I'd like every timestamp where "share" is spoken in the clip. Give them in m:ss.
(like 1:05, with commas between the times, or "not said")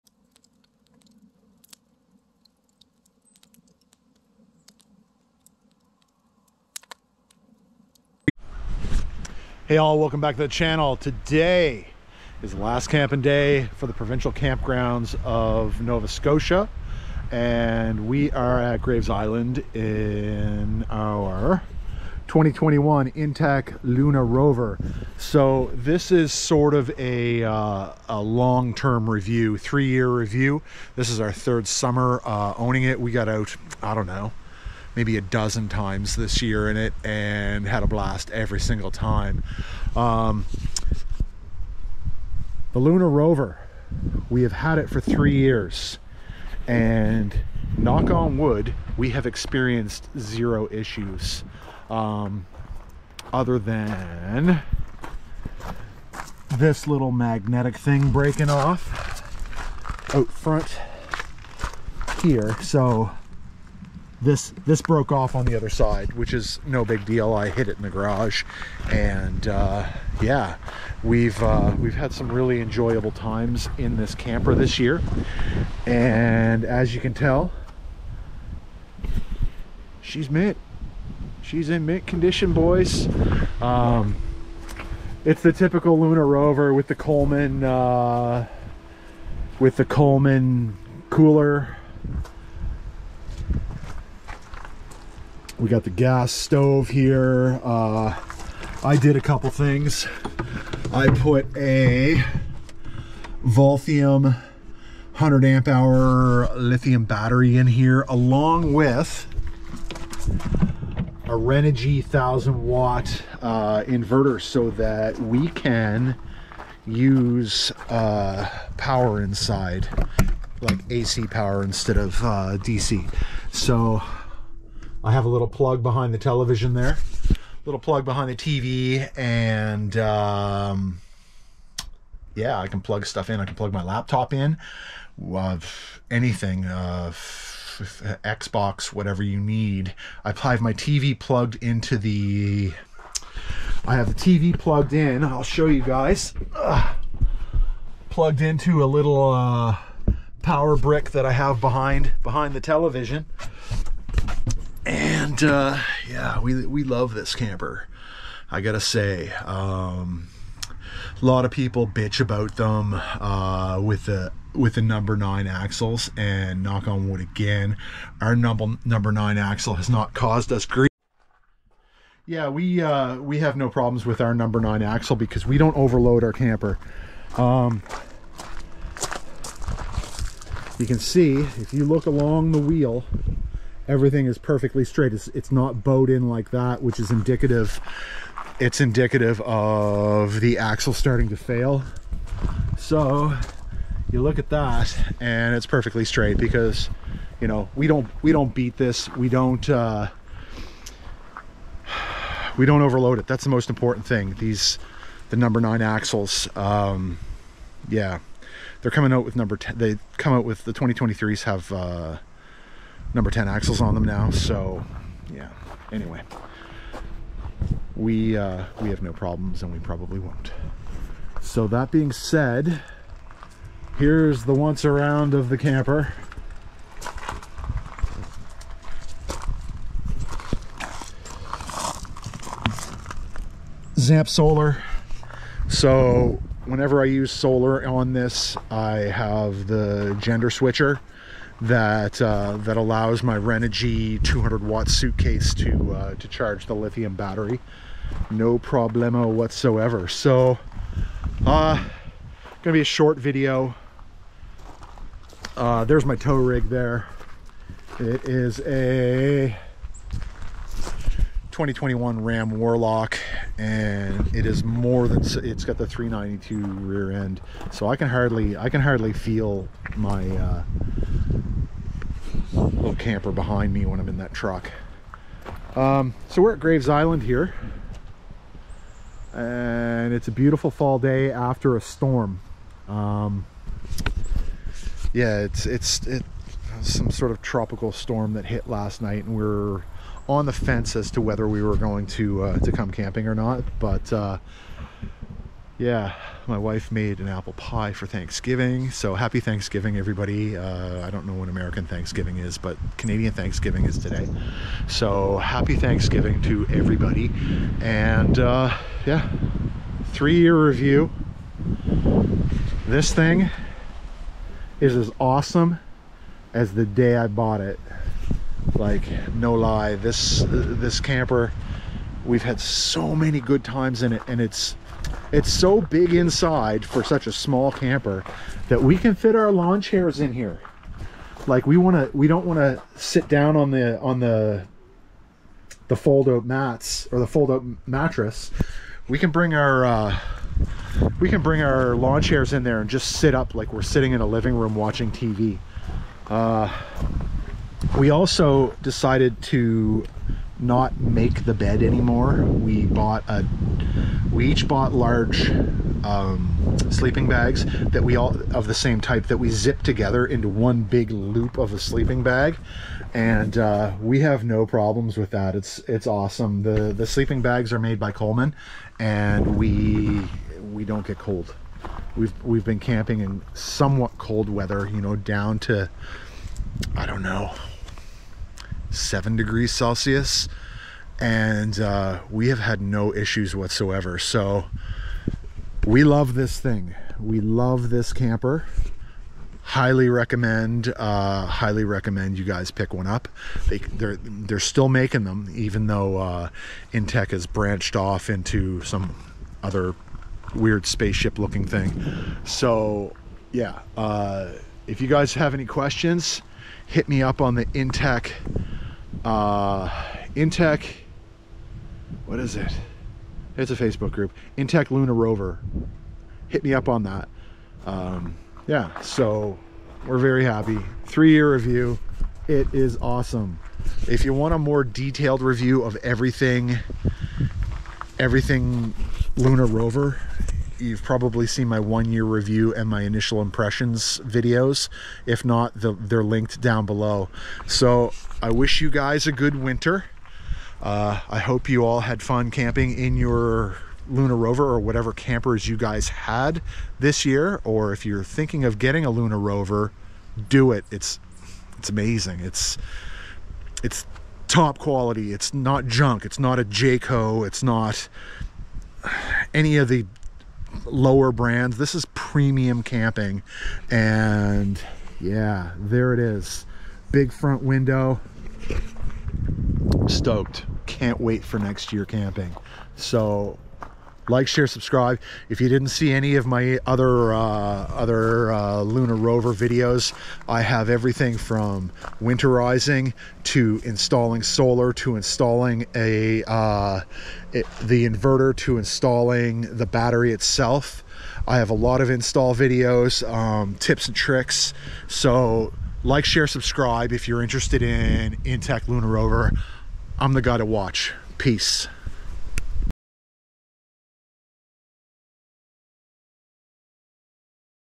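7:54, 8:16.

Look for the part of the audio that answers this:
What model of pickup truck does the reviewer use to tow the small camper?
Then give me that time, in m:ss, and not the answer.
4:22.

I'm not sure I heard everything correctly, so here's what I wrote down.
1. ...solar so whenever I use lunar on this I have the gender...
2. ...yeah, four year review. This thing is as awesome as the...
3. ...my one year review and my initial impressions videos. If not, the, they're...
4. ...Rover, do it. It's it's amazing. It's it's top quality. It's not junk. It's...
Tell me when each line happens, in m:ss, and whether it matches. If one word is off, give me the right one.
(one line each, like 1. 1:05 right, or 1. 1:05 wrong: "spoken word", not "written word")
1. 3:54 wrong: "solar", not "lunar"
2. 5:09 wrong: "three", not "four"
3. 7:11 right
4. 7:29 right.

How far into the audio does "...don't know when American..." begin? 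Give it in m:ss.
5:01.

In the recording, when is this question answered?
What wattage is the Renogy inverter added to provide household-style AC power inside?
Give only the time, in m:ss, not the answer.
1:52.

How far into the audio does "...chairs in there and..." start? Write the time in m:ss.
5:42.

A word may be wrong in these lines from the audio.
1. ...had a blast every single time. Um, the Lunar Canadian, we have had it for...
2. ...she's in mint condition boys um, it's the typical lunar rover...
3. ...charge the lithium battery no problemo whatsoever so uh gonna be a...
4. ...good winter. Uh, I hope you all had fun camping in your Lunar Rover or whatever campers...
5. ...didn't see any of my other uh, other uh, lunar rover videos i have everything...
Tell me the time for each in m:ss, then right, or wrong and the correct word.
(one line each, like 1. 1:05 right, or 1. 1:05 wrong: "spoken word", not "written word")
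1. 0:37 wrong: "Rover", not "Canadian"
2. 1:21 right
3. 4:06 right
4. 7:19 right
5. 7:55 right.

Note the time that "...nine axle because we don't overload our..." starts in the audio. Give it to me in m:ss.
2:54.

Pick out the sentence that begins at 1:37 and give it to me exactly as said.
Uh, I did a couple things.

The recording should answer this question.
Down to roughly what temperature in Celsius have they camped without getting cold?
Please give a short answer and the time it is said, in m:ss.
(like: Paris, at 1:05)
7 degrees, at 6:18.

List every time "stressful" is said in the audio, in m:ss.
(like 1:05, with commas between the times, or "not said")
not said.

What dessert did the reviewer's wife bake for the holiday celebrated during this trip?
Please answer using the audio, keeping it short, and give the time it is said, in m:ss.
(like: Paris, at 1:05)
Apple pie, at 4:57.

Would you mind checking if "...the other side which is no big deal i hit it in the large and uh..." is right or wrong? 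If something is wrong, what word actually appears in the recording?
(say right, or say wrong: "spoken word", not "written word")
wrong: "garage", not "large".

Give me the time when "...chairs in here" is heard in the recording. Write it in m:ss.
5:29.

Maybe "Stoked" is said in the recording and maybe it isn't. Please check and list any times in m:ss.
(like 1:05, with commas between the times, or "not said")
7:50.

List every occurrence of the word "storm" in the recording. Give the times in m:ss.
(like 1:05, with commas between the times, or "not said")
4:41, 4:47.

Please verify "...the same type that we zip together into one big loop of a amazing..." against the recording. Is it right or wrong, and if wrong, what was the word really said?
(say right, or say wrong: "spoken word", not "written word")
wrong: "sleeping", not "amazing".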